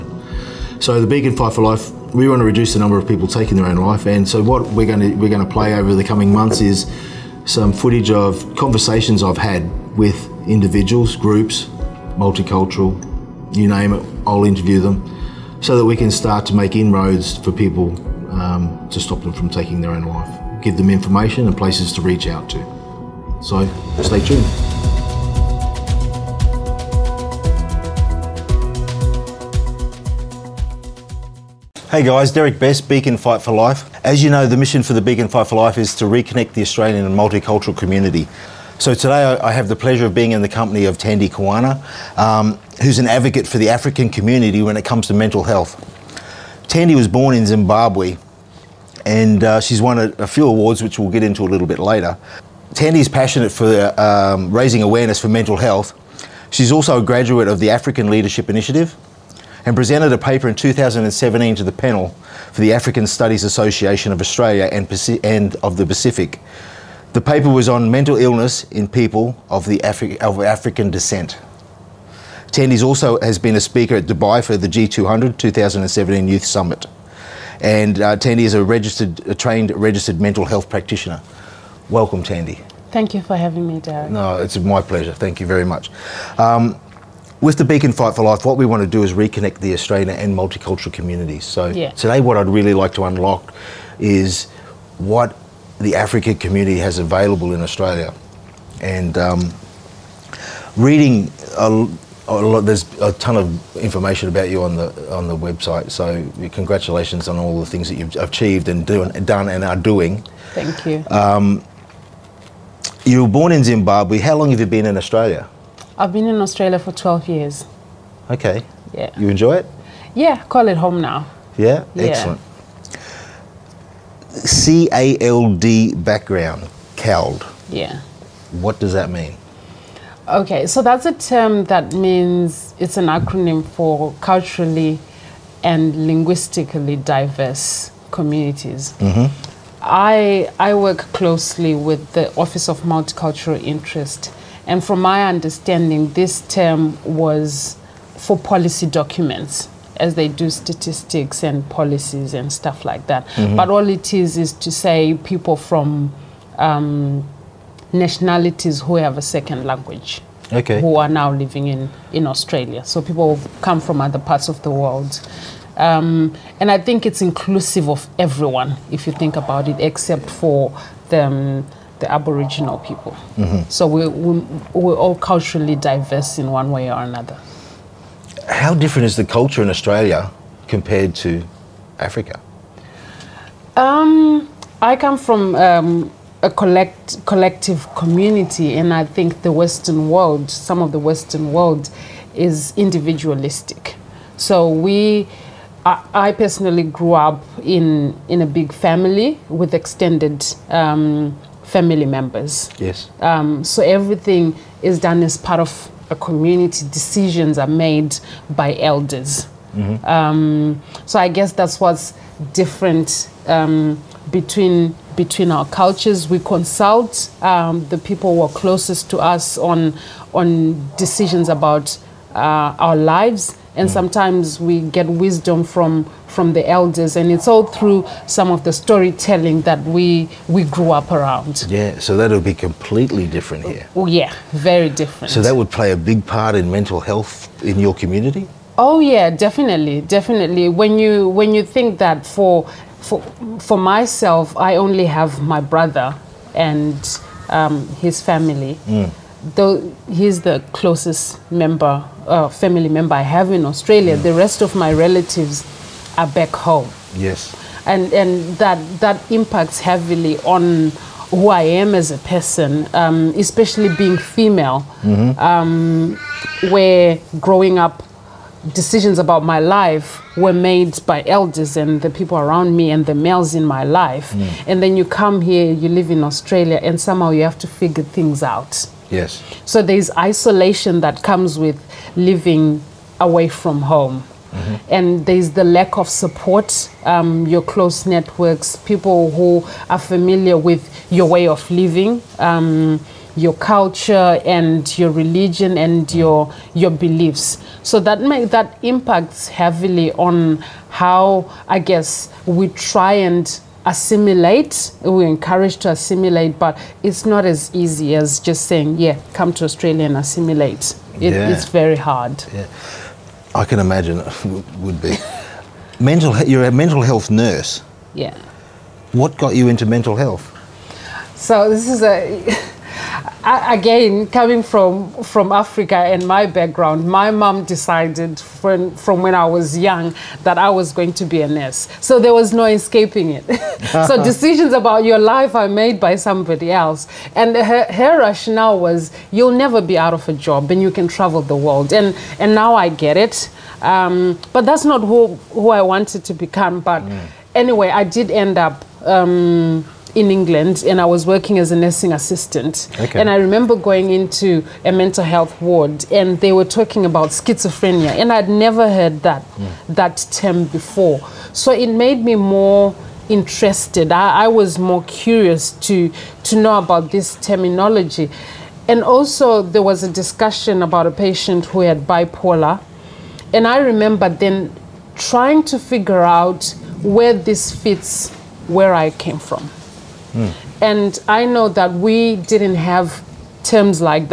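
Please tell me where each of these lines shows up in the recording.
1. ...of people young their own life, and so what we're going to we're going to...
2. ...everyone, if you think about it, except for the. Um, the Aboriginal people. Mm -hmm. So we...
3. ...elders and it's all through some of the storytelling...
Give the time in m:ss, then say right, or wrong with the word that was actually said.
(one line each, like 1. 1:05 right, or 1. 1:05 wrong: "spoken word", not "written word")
1. 0:02 wrong: "taking", not "young"
2. 2:48 right
3. 3:46 right.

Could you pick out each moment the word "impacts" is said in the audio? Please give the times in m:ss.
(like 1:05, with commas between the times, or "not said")
4:19, 4:58.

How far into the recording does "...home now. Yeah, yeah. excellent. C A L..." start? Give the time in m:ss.
2:00.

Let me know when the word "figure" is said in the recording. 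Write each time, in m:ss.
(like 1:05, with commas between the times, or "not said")
4:37, 6:15.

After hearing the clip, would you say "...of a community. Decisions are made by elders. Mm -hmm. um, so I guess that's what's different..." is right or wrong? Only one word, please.
right.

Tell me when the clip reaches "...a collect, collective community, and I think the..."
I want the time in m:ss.
3:06.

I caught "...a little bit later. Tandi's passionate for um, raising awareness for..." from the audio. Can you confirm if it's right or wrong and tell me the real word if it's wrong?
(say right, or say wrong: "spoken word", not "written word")
right.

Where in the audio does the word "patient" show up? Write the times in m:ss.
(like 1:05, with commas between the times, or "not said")
6:11.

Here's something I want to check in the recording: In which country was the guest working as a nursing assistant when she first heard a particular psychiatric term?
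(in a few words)
England.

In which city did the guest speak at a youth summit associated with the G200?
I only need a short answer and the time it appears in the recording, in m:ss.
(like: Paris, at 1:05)
Dubai, at 1:14.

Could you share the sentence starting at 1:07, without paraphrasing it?
The paper was on mental illness in people of, the Afri of African descent.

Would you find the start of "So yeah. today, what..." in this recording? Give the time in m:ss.
1:31.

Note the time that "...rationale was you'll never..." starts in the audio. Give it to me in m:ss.
5:38.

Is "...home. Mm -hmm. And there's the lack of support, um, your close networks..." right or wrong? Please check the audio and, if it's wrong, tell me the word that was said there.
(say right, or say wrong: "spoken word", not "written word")
right.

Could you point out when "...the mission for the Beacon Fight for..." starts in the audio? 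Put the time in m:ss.
0:34.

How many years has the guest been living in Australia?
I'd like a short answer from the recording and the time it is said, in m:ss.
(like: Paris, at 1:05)
12, at 1:56.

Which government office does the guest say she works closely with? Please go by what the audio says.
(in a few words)
Office of Multicultural Interest.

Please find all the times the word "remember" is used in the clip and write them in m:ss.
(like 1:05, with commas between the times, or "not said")
5:53, 6:13.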